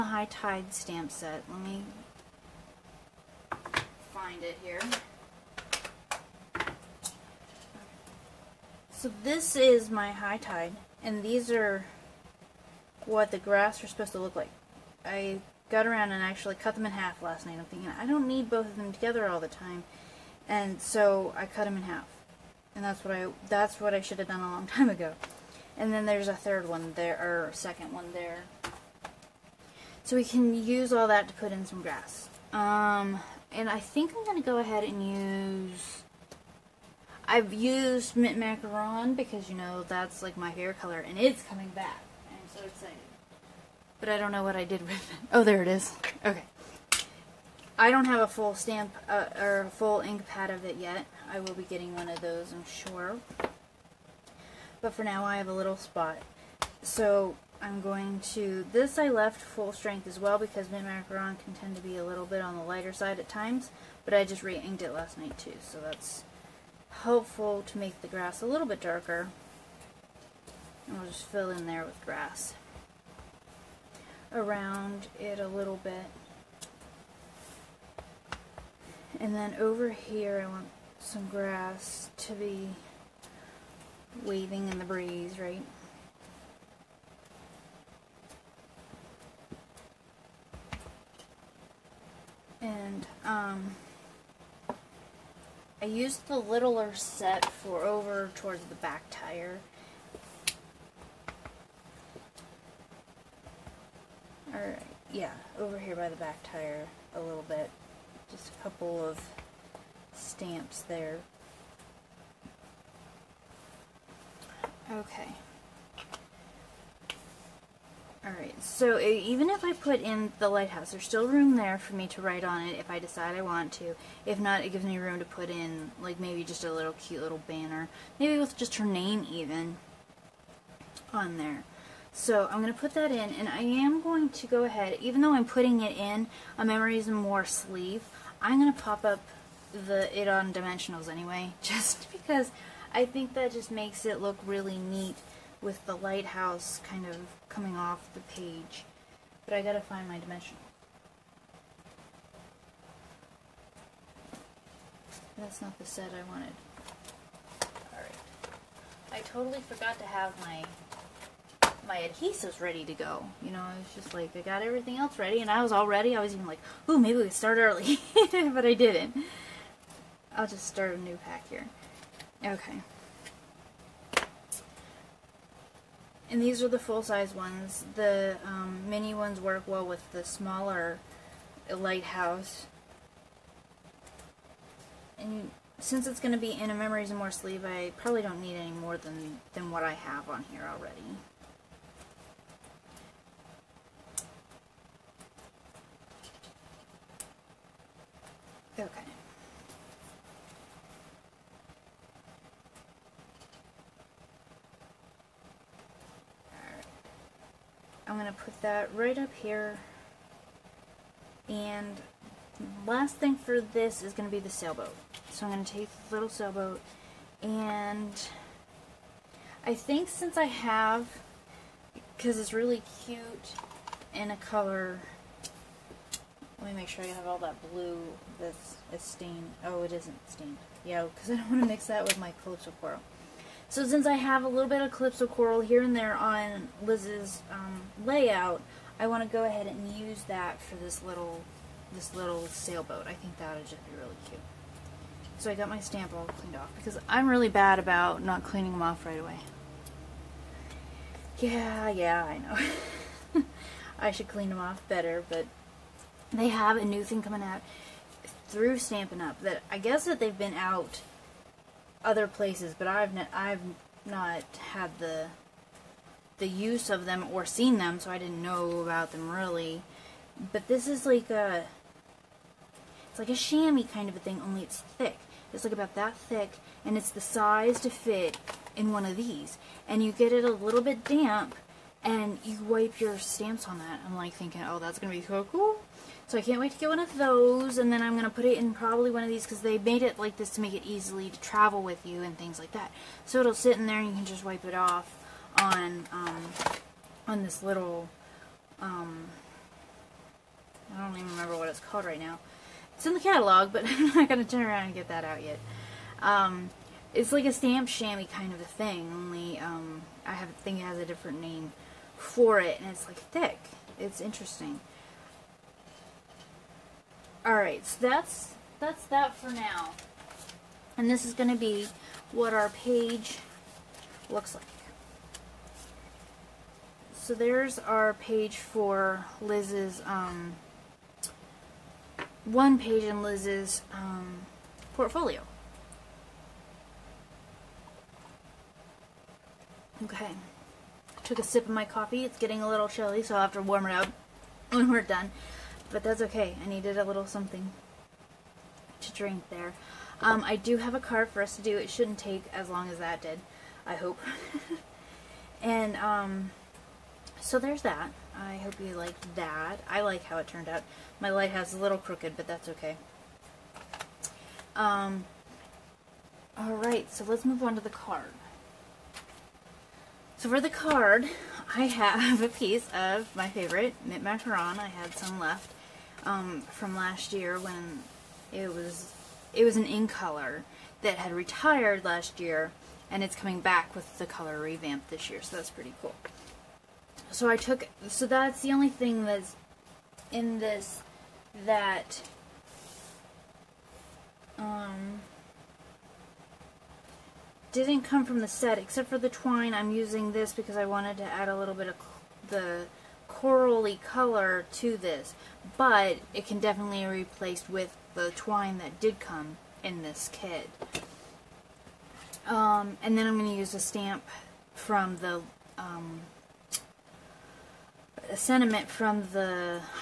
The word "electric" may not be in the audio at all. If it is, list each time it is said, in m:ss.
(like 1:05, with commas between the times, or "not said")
not said.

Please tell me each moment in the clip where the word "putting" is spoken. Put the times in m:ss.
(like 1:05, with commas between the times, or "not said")
2:15.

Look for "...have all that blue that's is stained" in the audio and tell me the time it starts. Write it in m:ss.
3:47.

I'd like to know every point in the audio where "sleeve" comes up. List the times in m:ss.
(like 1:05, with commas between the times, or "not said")
2:17, 3:07.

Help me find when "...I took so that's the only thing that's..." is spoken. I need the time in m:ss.
6:27.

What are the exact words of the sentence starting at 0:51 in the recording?
I will be getting one of those, I'm sure.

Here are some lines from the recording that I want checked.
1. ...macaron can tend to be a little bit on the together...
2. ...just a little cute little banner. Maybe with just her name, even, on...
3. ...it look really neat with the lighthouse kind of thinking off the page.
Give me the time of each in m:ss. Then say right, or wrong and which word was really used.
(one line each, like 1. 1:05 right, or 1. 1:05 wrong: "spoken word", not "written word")
1. 1:00 wrong: "lighter", not "together"
2. 2:06 right
3. 2:24 wrong: "coming", not "thinking".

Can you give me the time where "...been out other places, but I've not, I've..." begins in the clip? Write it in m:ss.
4:20.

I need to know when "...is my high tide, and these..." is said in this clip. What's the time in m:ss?
0:09.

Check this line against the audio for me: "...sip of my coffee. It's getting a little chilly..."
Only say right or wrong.
right.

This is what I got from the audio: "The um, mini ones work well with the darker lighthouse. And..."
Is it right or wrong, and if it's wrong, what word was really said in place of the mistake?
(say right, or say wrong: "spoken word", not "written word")
wrong: "smaller", not "darker".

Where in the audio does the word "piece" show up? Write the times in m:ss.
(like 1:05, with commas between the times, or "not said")
6:12.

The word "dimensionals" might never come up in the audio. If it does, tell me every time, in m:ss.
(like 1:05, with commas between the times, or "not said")
2:20, 2:30.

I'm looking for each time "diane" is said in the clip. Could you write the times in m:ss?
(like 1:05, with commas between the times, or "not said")
not said.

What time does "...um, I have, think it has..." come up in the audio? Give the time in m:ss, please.
5:09.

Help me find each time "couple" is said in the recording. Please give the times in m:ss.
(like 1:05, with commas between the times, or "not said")
1:48.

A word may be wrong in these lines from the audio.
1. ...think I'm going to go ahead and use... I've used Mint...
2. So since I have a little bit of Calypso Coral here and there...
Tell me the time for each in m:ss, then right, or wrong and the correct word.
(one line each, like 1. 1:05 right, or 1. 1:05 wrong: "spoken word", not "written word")
1. 0:33 right
2. 3:53 right.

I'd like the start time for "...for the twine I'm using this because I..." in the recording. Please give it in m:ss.
6:39.